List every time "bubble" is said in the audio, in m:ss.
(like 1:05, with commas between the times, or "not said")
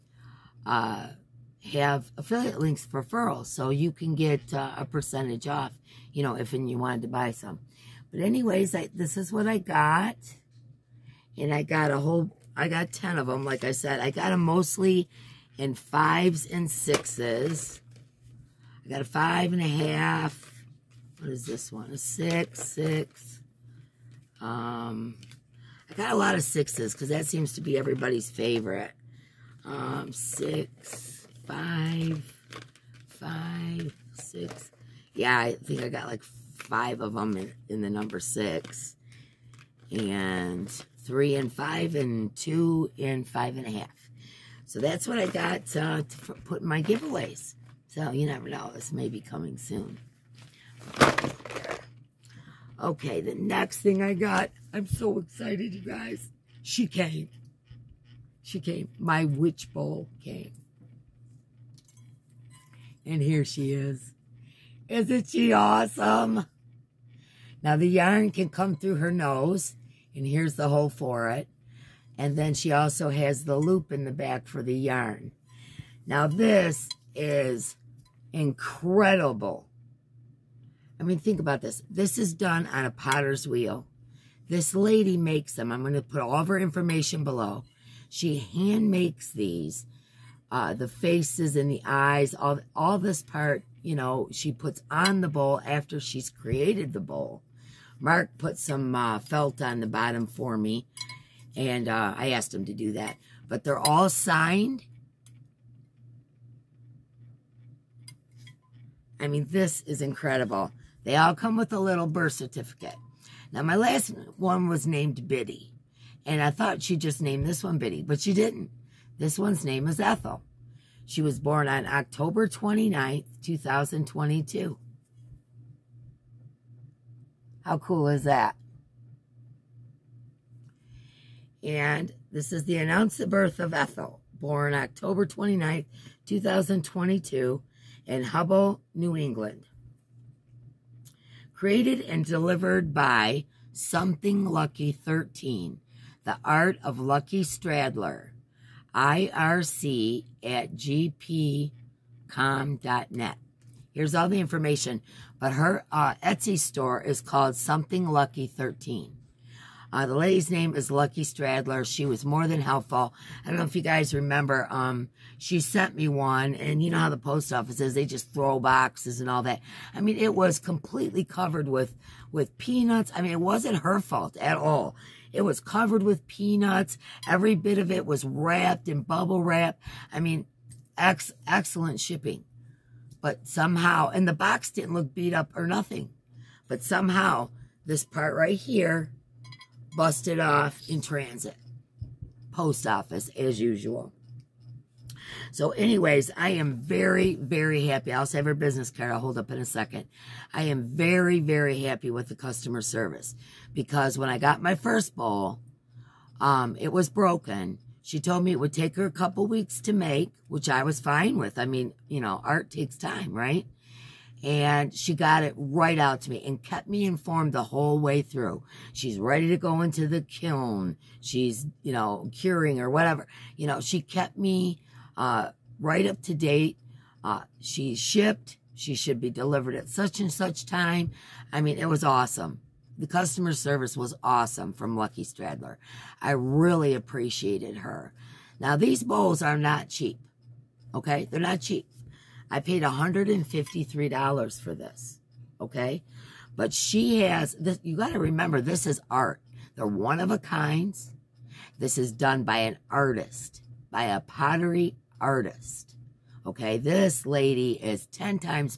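2:59.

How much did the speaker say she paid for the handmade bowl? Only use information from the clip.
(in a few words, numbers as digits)
$153.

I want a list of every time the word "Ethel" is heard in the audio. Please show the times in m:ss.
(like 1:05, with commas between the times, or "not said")
1:59, 2:13.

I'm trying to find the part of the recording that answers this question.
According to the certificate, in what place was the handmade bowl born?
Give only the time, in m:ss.
2:18.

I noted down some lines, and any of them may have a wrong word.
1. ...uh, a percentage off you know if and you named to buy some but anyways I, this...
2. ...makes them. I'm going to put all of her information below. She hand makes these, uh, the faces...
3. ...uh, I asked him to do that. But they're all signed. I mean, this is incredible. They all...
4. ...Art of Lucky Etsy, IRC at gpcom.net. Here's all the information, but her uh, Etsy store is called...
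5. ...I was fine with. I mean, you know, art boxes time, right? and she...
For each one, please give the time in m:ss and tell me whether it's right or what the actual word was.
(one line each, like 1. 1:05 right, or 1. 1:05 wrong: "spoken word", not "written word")
1. 0:04 wrong: "wanted", not "named"
2. 1:25 right
3. 1:41 right
4. 2:26 wrong: "Stradley", not "Etsy"
5. 3:30 wrong: "takes", not "boxes".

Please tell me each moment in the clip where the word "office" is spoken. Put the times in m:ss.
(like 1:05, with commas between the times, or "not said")
2:47, 3:12.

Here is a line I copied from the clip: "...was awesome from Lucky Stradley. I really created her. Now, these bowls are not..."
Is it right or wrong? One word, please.
wrong.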